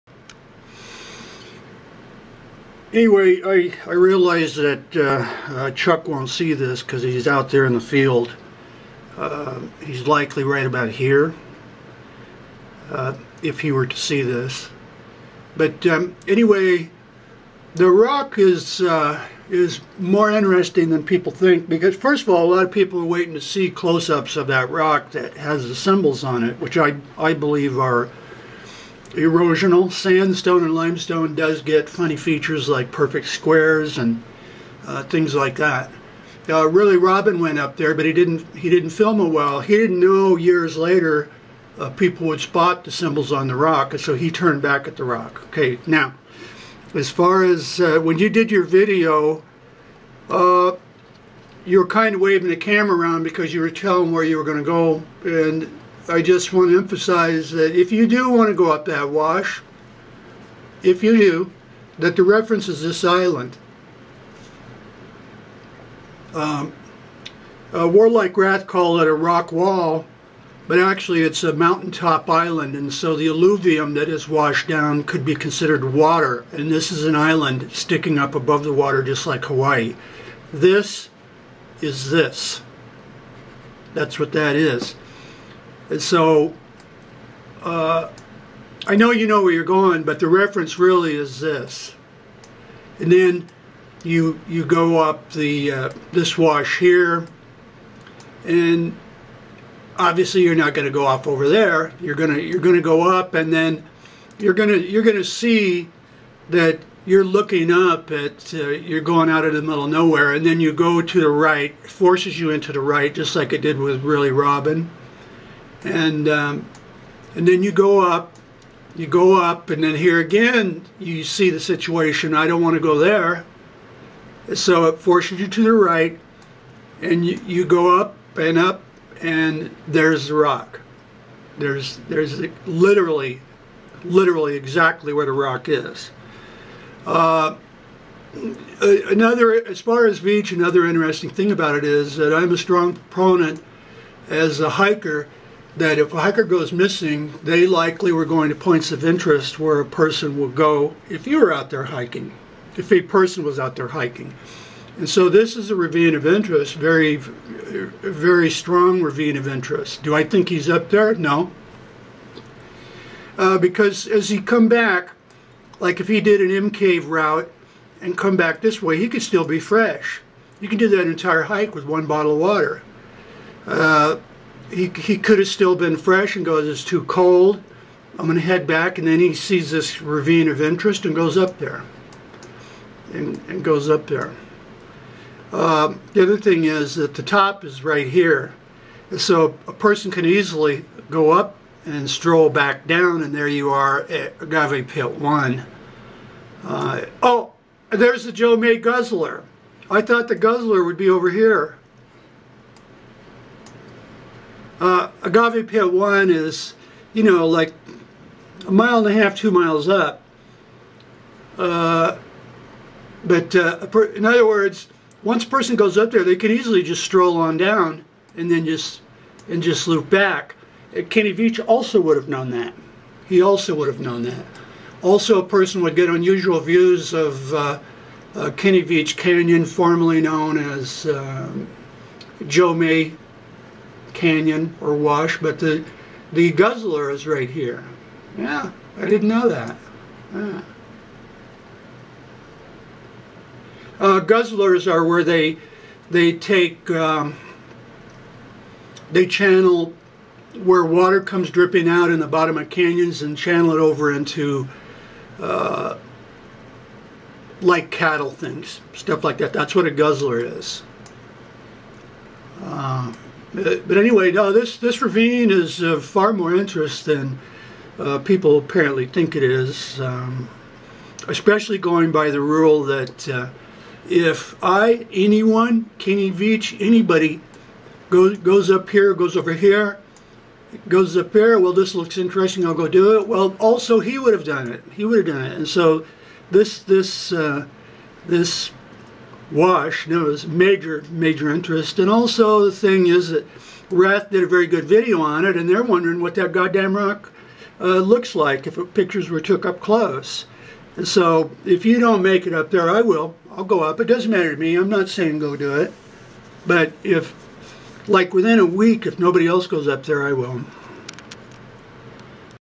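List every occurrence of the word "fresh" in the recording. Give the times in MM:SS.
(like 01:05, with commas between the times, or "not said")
02:49, 02:55.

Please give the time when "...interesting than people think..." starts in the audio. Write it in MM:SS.
00:20.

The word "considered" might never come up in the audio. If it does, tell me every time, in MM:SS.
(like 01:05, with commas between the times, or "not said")
01:15.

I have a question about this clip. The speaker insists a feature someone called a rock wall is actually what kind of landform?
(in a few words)
Mountaintop island.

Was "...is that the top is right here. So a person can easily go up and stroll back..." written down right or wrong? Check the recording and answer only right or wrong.
right.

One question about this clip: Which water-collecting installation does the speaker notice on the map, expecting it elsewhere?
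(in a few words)
Joe May Guzzler.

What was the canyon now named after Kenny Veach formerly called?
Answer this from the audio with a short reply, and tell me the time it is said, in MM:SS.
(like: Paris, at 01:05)
Joe May canyon, at 03:52.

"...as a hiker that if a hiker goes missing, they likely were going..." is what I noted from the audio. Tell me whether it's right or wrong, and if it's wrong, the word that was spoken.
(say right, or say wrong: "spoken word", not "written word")
right.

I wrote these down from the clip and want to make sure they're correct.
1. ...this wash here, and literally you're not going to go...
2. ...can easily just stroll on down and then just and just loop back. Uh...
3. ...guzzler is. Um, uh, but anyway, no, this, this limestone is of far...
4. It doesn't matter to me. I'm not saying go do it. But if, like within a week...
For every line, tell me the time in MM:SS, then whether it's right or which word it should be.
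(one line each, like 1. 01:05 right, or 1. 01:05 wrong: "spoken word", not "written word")
1. 01:36 wrong: "obviously", not "literally"
2. 03:36 right
3. 04:19 wrong: "ravine", not "limestone"
4. 05:03 right.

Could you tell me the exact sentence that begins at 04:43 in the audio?
Well, also he would have done it.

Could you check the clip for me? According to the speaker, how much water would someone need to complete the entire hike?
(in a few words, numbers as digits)
1 bottle.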